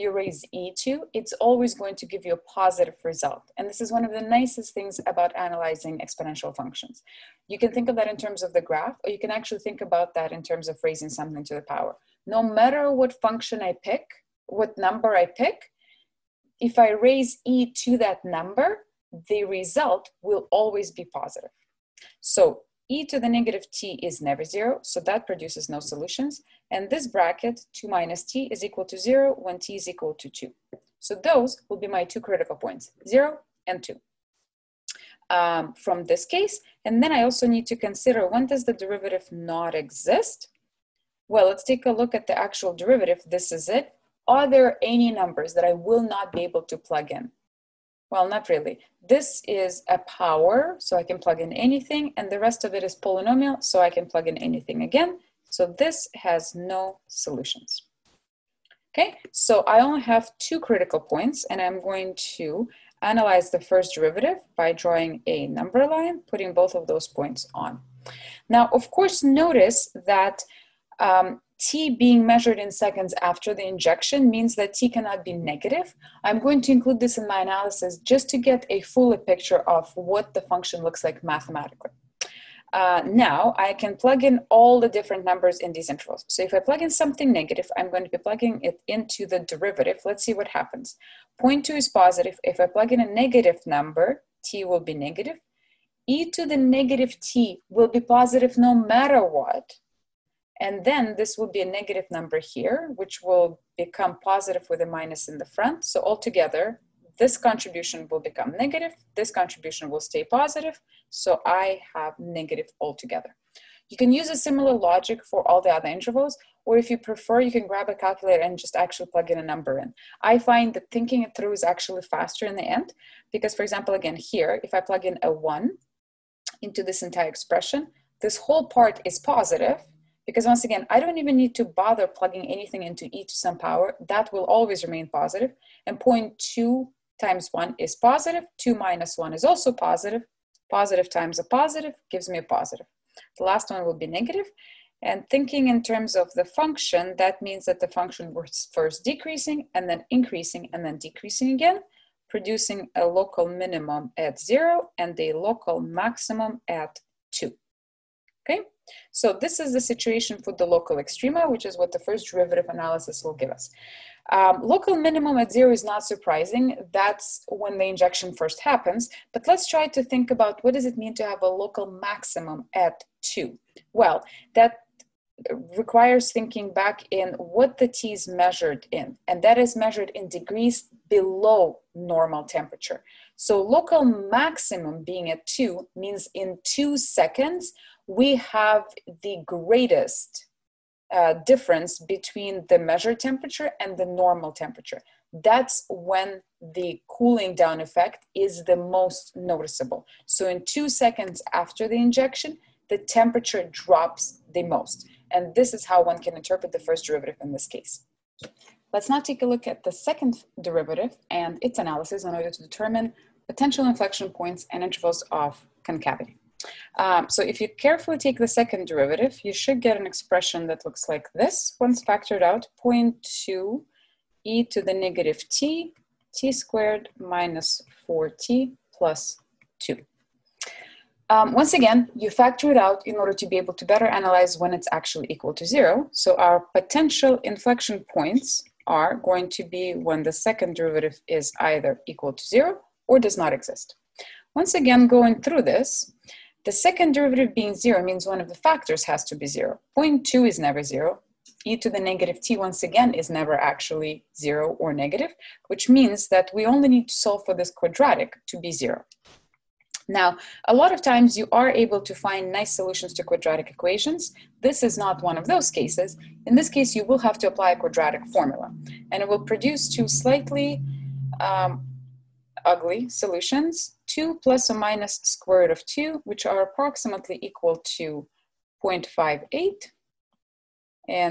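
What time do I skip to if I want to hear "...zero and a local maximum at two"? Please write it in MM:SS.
02:34.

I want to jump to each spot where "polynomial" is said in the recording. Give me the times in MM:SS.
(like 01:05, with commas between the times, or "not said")
00:52.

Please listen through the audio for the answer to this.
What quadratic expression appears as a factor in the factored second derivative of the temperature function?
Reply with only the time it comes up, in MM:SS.
03:46.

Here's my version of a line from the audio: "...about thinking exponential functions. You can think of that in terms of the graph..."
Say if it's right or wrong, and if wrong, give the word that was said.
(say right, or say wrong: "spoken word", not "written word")
wrong: "analyzing", not "thinking".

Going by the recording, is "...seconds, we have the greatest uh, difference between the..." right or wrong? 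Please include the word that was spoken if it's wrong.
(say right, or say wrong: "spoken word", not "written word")
right.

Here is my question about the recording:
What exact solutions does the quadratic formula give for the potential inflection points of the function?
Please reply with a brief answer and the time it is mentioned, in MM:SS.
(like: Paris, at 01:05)
2 ± √2, at 04:34.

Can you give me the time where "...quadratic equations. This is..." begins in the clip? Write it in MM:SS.
04:23.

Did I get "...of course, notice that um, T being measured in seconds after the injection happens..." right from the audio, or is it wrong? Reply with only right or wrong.
wrong.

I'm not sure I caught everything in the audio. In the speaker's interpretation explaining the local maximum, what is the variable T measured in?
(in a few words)
degrees below normal temperature.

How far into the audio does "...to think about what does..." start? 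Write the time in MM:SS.
02:49.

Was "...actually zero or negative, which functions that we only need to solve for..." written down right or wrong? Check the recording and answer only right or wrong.
wrong.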